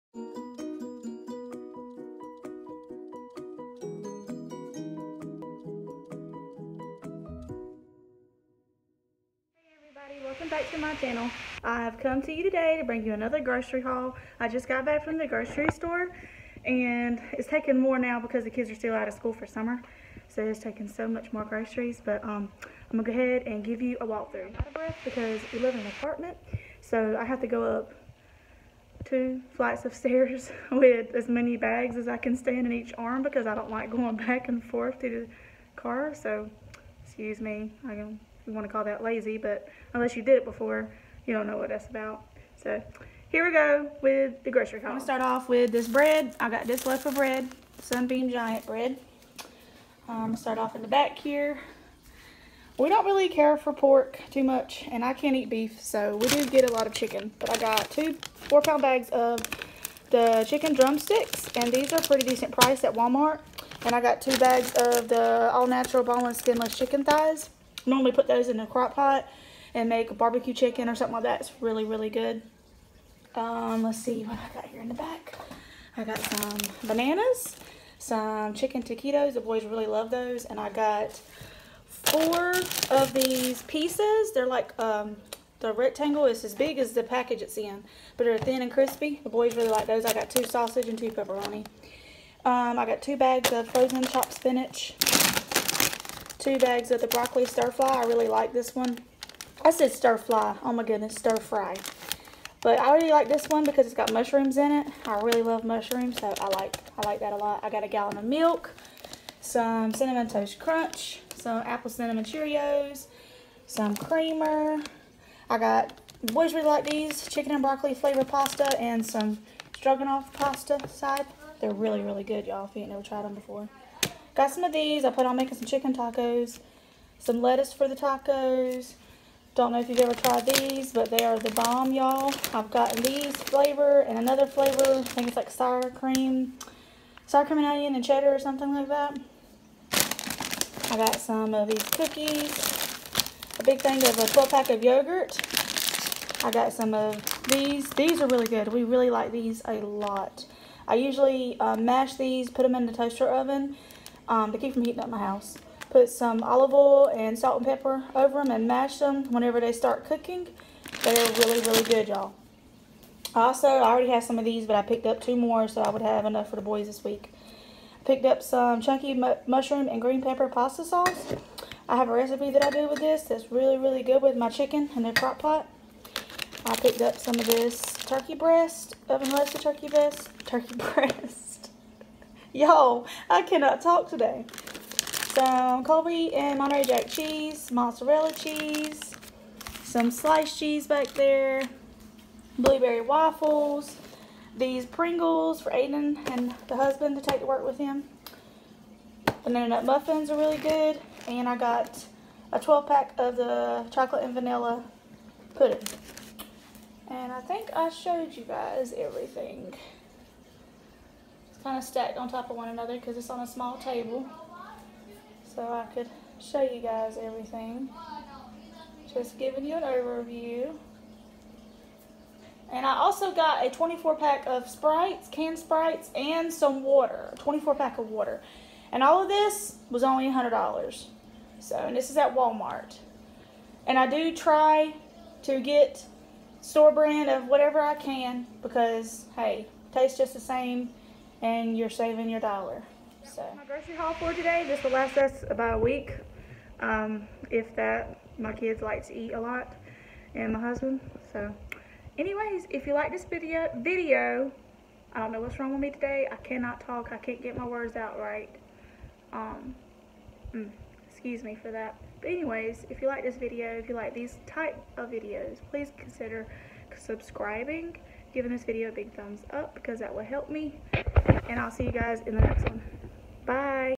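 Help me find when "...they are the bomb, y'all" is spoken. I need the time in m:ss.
2:11.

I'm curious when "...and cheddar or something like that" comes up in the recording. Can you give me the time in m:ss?
2:17.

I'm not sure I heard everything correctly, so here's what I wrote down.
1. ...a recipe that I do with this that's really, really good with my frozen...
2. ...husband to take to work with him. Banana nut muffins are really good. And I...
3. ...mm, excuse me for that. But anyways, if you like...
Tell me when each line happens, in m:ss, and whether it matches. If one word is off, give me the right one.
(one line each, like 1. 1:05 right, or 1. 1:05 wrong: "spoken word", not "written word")
1. 2:52 wrong: "chicken", not "frozen"
2. 3:16 right
3. 4:20 right.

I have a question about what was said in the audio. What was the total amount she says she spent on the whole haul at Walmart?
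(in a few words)
$100.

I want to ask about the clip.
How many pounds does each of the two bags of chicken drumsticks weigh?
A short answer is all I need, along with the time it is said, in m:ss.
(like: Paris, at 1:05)
4, at 0:58.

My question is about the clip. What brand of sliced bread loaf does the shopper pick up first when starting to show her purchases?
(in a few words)
Sunbeam Giant.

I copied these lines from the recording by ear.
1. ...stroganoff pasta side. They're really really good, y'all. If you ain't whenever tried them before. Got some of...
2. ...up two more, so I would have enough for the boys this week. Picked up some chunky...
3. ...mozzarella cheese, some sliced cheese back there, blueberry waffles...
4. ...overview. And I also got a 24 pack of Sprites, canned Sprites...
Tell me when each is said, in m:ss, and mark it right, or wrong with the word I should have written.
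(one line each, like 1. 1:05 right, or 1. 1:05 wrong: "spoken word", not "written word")
1. 1:59 wrong: "never", not "whenever"
2. 2:45 right
3. 3:07 right
4. 3:39 right.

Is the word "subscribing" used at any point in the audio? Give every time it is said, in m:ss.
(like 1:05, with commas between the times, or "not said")
4:26.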